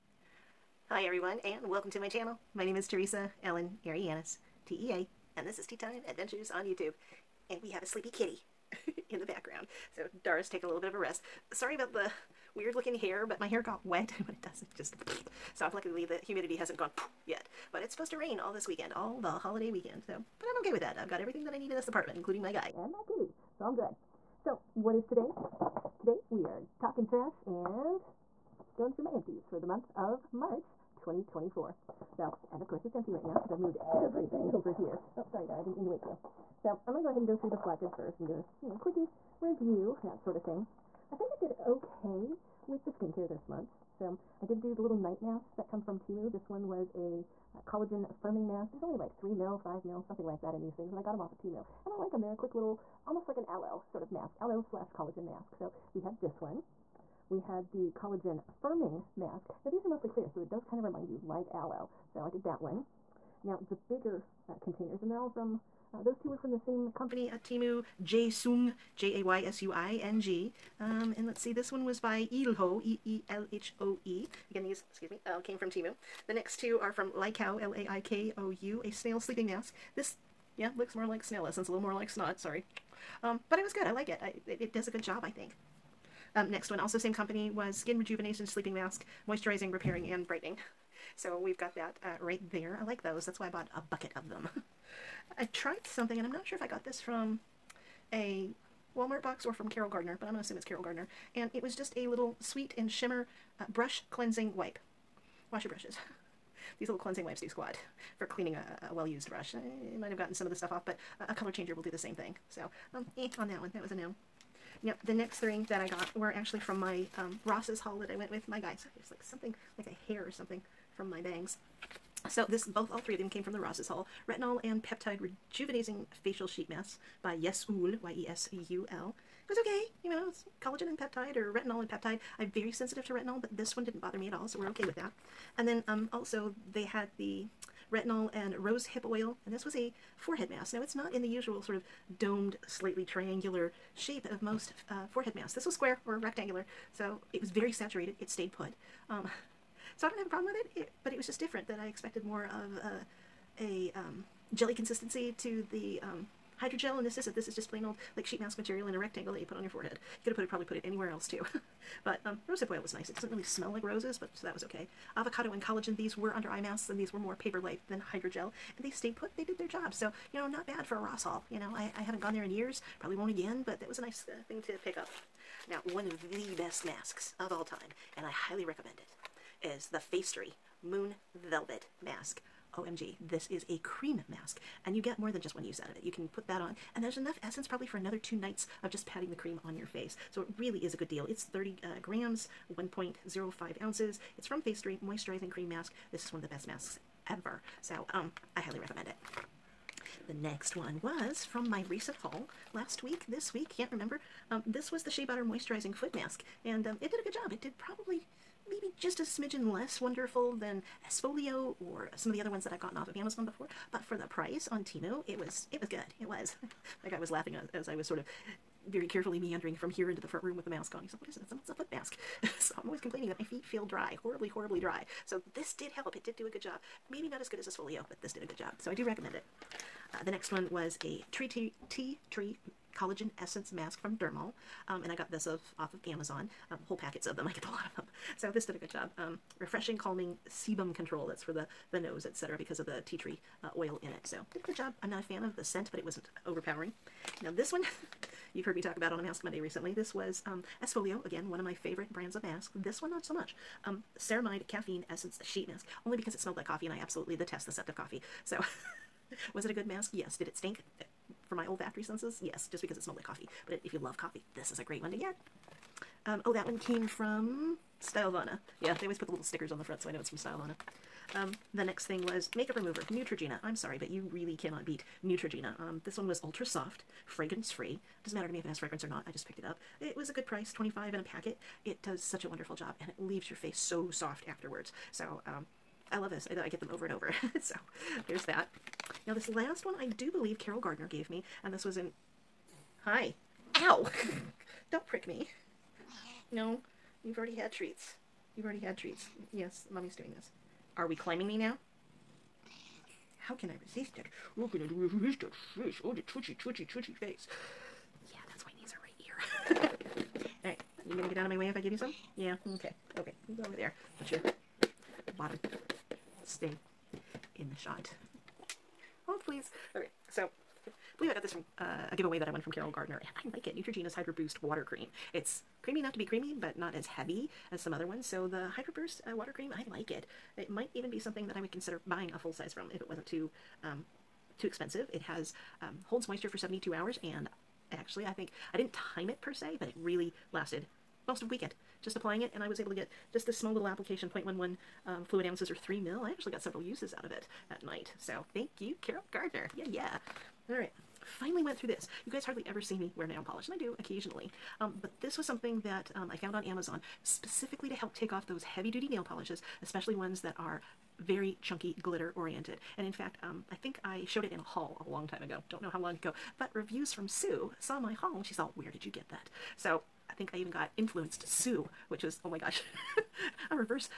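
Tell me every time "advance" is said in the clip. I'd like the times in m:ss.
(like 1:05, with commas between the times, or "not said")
not said.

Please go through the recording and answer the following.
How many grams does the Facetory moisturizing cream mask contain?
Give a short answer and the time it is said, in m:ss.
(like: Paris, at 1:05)
30 grams, at 3:11.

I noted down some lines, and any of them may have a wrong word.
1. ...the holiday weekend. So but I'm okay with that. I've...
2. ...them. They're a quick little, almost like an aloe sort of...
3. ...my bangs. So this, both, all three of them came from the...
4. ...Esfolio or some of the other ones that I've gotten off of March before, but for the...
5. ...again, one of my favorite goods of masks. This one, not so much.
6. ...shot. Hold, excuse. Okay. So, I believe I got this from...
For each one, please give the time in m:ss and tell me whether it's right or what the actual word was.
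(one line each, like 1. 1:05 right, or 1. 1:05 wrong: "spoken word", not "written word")
1. 0:19 right
2. 0:52 right
3. 2:01 right
4. 3:31 wrong: "Amazon", not "March"
5. 4:11 wrong: "brands", not "goods"
6. 5:17 wrong: "please", not "excuse".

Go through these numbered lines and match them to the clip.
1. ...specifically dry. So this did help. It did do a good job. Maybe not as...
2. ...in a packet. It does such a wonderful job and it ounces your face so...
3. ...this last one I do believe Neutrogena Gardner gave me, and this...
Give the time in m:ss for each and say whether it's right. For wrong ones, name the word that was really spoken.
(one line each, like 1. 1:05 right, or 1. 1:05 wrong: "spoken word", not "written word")
1. 3:44 wrong: "horribly", not "specifically"
2. 4:41 wrong: "leaves", not "ounces"
3. 4:49 wrong: "Carol", not "Neutrogena".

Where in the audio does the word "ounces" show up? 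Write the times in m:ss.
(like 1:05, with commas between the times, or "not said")
3:13, 5:45.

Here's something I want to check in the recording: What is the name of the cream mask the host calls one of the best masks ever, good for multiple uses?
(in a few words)
Moon Velvet.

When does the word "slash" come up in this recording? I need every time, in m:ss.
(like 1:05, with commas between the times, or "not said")
0:54.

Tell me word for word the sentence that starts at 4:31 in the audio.
Um, the next thing was makeup remover, Neutrogena.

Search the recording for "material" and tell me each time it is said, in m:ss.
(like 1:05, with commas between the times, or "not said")
2:38.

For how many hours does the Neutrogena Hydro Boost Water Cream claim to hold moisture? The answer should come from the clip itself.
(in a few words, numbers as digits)
72.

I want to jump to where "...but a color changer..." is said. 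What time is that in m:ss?
1:50.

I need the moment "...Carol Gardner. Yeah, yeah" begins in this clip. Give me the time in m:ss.
5:49.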